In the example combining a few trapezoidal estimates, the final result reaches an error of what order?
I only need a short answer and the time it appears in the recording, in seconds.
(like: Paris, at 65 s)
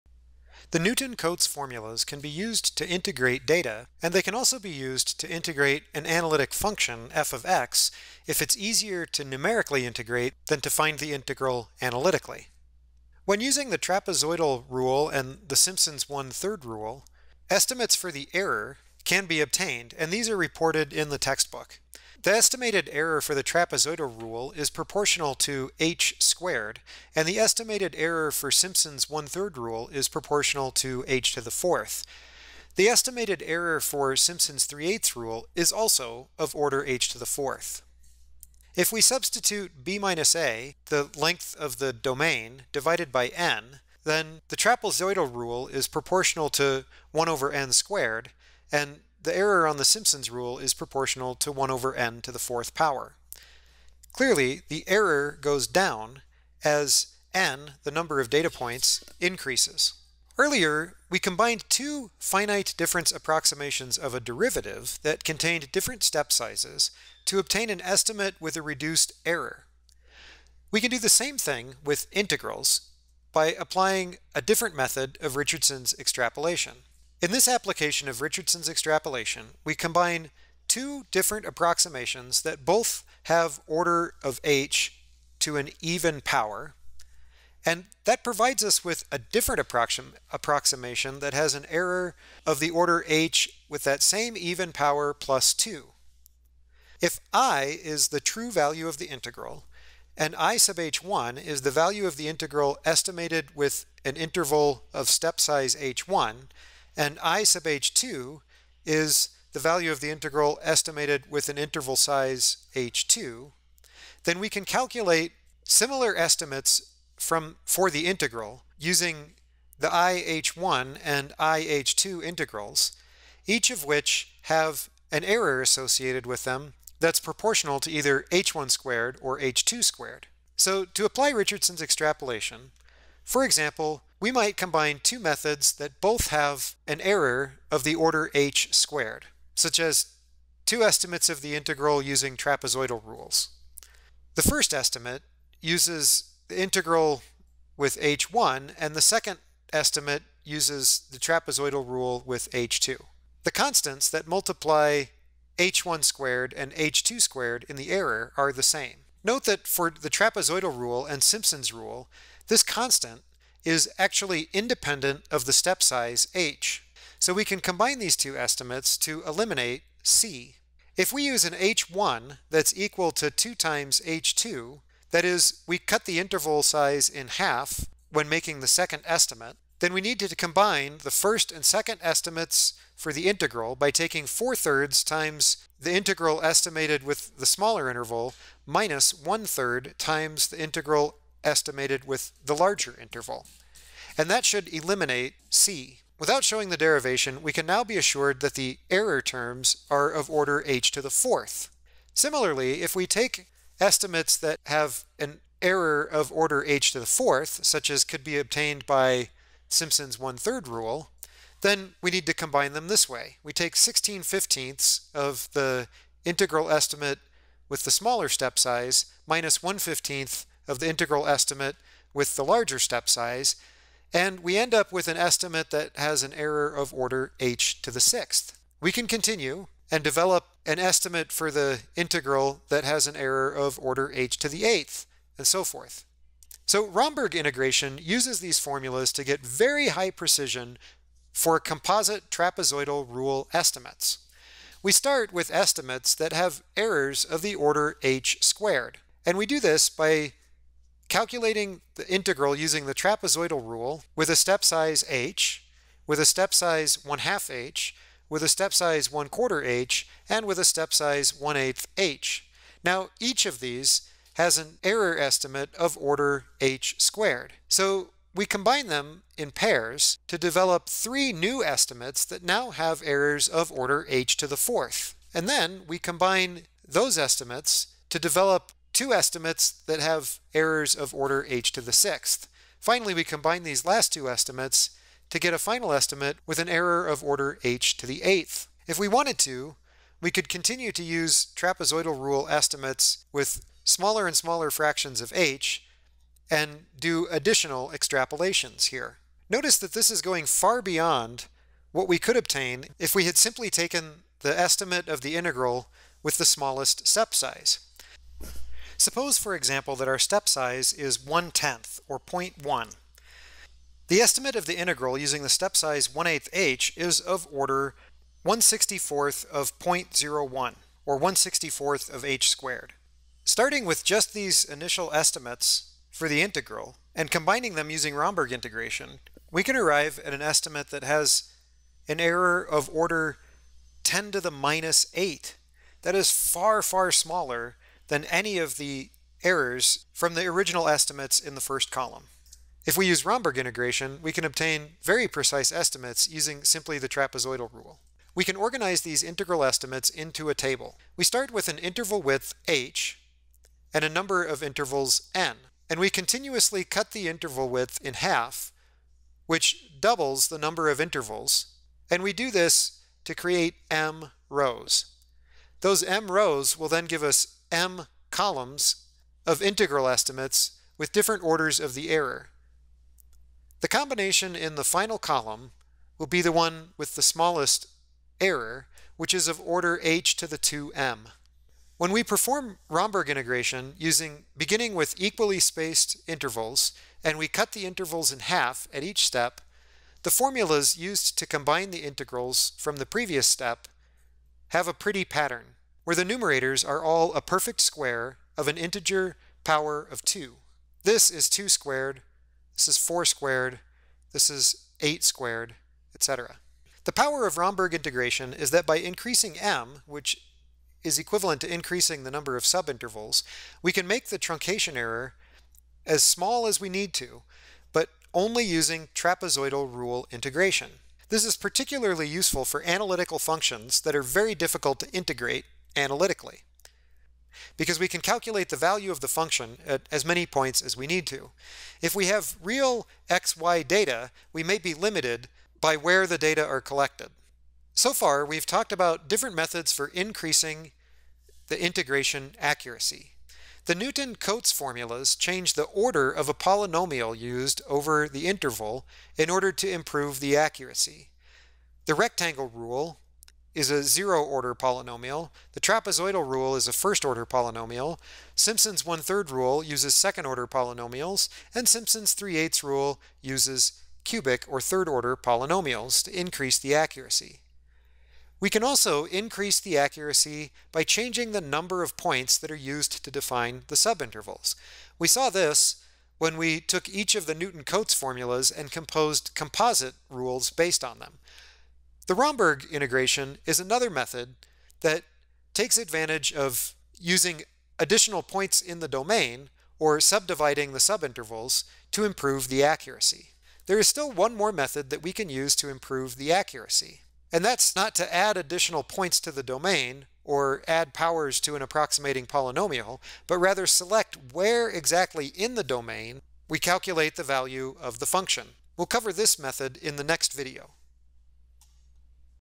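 10 to the minus 8, at 334 s.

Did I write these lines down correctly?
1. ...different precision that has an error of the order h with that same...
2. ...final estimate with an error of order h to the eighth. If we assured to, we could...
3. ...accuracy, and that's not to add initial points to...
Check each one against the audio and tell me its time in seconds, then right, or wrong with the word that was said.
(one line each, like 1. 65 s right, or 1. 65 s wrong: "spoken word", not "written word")
1. 89 s wrong: "approximation", not "precision"
2. 285 s wrong: "wanted", not "assured"
3. 496 s wrong: "additional", not "initial".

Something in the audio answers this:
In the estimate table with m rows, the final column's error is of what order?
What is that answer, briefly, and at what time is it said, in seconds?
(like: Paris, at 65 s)
h to the 2m, at 380 s.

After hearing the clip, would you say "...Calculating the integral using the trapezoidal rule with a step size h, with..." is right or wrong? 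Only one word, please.
right.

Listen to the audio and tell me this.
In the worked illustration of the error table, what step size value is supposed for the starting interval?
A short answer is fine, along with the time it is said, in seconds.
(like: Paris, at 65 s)
0.1, at 312 s.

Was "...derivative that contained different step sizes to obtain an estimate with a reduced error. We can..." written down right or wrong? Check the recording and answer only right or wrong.
right.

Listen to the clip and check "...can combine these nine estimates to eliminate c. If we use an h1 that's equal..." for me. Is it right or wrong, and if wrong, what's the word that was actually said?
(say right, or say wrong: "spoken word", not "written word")
wrong: "two", not "nine".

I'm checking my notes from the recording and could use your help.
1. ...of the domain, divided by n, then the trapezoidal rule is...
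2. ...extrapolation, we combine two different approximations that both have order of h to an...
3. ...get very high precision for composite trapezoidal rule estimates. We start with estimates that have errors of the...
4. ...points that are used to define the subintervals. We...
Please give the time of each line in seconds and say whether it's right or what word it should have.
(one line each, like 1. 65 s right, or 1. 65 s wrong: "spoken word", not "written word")
1. 41 s right
2. 78 s right
3. 239 s right
4. 472 s right.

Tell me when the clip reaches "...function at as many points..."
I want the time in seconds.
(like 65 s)
429 s.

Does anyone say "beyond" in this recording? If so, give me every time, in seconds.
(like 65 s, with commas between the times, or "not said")
300 s.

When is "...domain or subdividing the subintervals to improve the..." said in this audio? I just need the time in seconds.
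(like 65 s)
489 s.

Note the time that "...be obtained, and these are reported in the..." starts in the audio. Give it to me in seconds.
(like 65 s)
19 s.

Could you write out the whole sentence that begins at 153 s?
The constants that multiply h1 squared and h2 squared in the error are the same.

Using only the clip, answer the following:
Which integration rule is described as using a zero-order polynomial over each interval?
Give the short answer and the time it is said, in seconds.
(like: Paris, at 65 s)
rectangle rule, at 452 s.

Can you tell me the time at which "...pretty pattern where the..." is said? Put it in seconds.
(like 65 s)
394 s.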